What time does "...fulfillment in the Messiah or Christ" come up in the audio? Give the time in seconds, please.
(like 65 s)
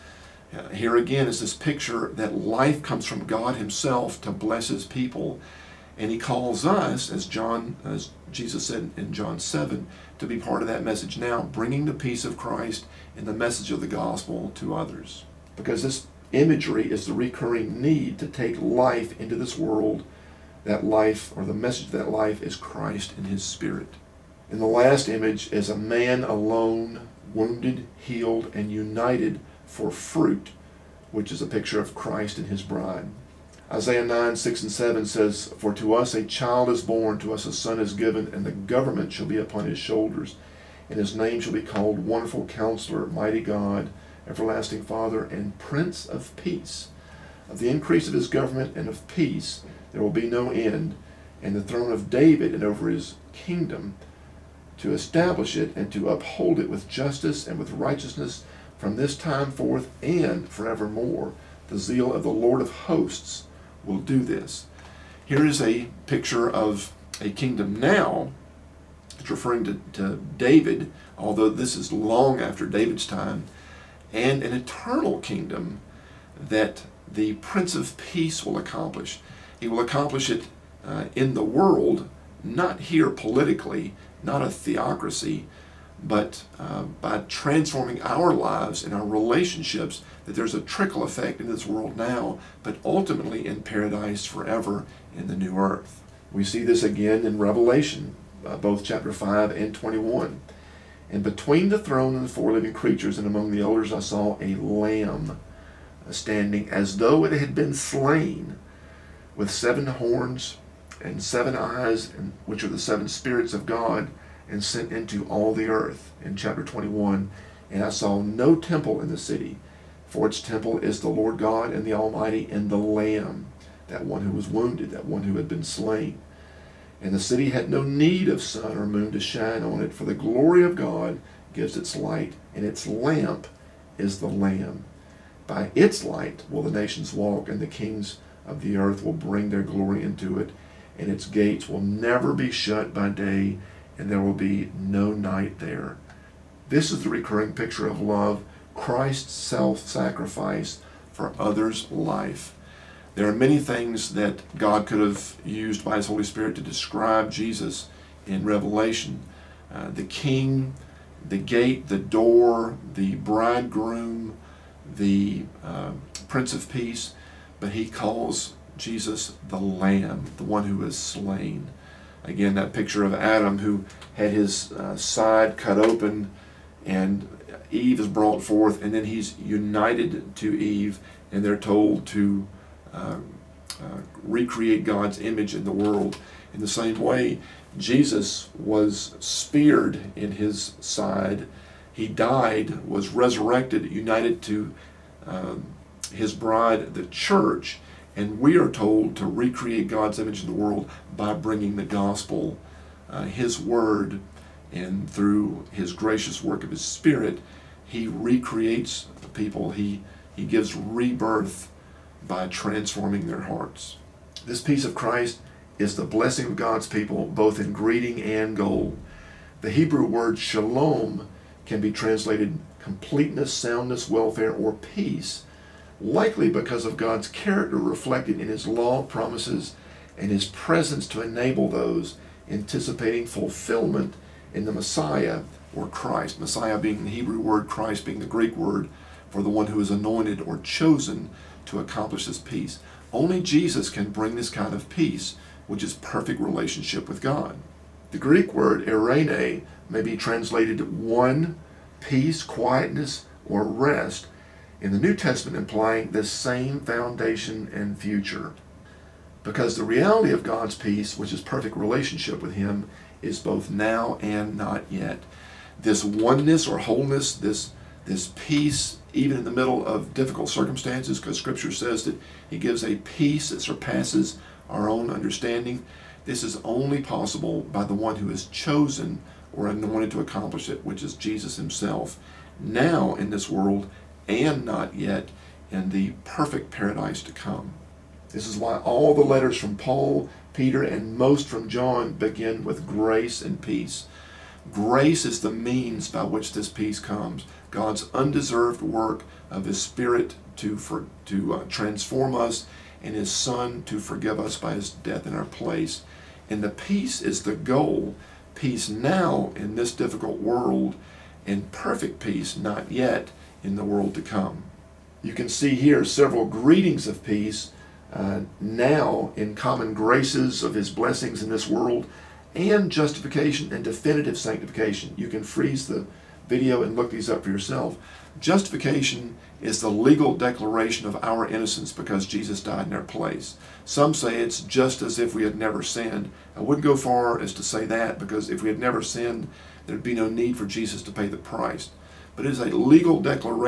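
233 s.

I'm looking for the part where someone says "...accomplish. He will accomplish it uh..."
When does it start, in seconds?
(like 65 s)
78 s.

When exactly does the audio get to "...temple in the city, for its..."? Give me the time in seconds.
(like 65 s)
118 s.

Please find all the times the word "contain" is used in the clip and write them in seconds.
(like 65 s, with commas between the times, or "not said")
not said.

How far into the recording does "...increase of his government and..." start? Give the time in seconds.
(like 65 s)
47 s.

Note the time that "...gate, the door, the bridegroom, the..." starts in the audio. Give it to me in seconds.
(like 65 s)
161 s.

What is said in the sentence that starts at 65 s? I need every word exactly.
Here is a picture of a kingdom now.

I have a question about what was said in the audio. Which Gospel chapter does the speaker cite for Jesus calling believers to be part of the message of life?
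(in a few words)
John 7.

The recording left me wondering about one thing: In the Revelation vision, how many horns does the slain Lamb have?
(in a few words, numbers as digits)
7.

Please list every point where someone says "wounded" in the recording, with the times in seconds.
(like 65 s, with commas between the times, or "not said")
27 s, 124 s.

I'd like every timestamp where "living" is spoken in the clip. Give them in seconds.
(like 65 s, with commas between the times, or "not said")
102 s.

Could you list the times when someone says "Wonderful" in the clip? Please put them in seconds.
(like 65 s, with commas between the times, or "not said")
42 s.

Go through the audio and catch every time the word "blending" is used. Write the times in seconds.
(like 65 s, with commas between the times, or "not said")
not said.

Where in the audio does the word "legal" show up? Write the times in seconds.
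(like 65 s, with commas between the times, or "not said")
329 s, 342 s.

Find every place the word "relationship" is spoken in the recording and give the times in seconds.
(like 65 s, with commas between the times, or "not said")
89 s, 246 s, 261 s.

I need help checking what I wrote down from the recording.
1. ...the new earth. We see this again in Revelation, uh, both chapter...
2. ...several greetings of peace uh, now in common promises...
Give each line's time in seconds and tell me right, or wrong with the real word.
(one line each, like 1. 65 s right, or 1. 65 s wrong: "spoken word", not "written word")
1. 95 s right
2. 316 s wrong: "graces", not "promises".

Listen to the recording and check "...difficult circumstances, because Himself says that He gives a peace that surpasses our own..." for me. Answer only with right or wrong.
wrong.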